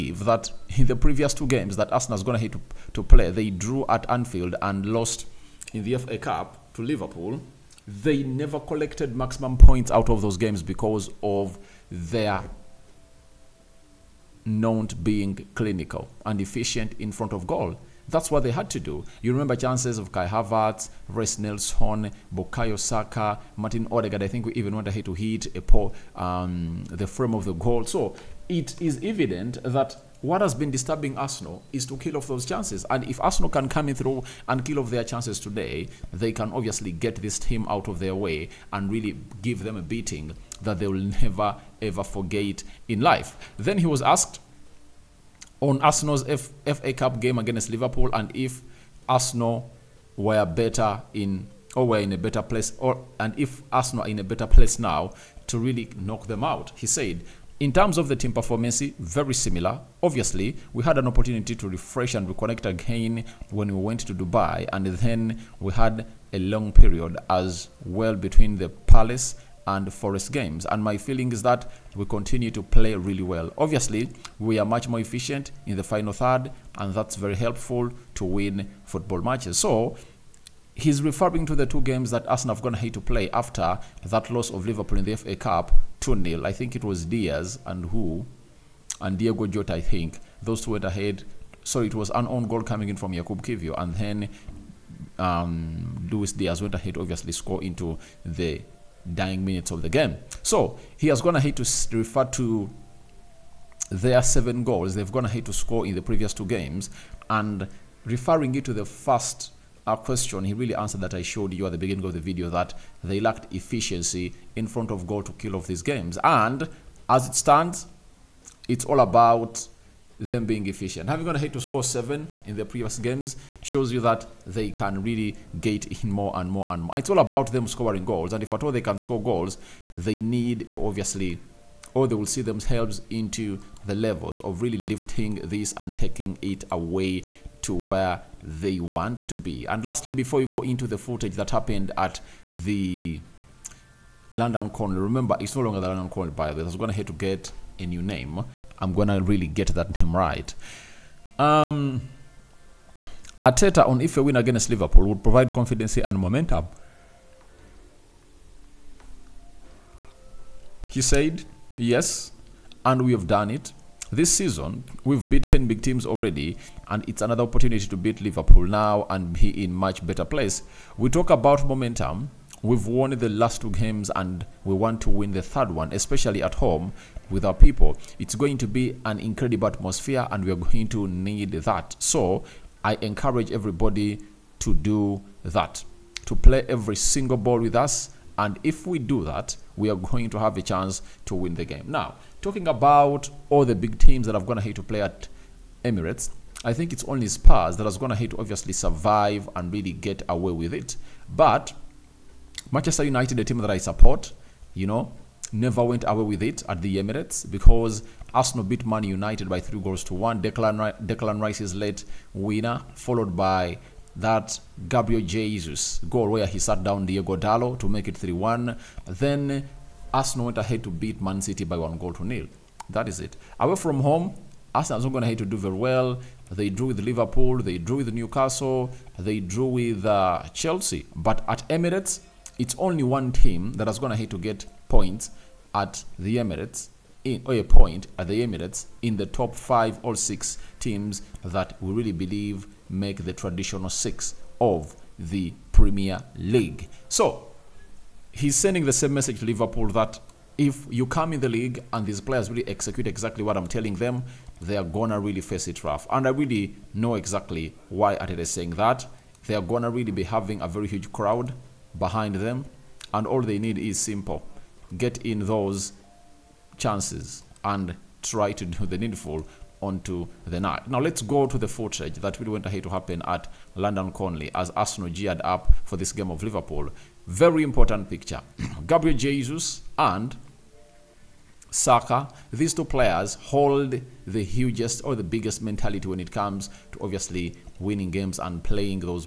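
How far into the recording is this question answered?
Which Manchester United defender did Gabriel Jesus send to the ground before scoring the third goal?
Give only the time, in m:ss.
3:37.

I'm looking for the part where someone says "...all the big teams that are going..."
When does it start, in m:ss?
3:13.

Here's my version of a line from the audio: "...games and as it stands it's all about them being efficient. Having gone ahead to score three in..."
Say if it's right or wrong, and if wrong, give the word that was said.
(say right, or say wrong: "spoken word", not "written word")
wrong: "seven", not "three".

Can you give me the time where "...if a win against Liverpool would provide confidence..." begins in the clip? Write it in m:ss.
2:34.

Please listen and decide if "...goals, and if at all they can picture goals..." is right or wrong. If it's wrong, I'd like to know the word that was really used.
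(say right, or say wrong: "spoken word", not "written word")
wrong: "score", not "picture".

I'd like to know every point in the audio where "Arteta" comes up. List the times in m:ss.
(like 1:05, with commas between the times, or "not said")
2:33, 4:18.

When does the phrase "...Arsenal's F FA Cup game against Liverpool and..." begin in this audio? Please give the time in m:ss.
0:45.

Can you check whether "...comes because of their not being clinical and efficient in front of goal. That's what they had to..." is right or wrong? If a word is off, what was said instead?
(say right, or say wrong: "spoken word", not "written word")
wrong: "games", not "comes".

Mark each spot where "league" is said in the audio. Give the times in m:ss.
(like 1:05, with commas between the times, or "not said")
4:06, 4:11.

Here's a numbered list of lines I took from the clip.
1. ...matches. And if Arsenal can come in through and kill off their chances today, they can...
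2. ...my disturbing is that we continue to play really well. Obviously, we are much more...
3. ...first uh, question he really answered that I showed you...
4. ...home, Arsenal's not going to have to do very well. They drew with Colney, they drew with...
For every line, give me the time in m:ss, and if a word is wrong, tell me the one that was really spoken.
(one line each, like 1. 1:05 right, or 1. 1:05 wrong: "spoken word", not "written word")
1. 0:32 wrong: "chances", not "matches"
2. 1:10 wrong: "feeling", not "disturbing"
3. 1:48 right
4. 3:44 wrong: "Liverpool", not "Colney".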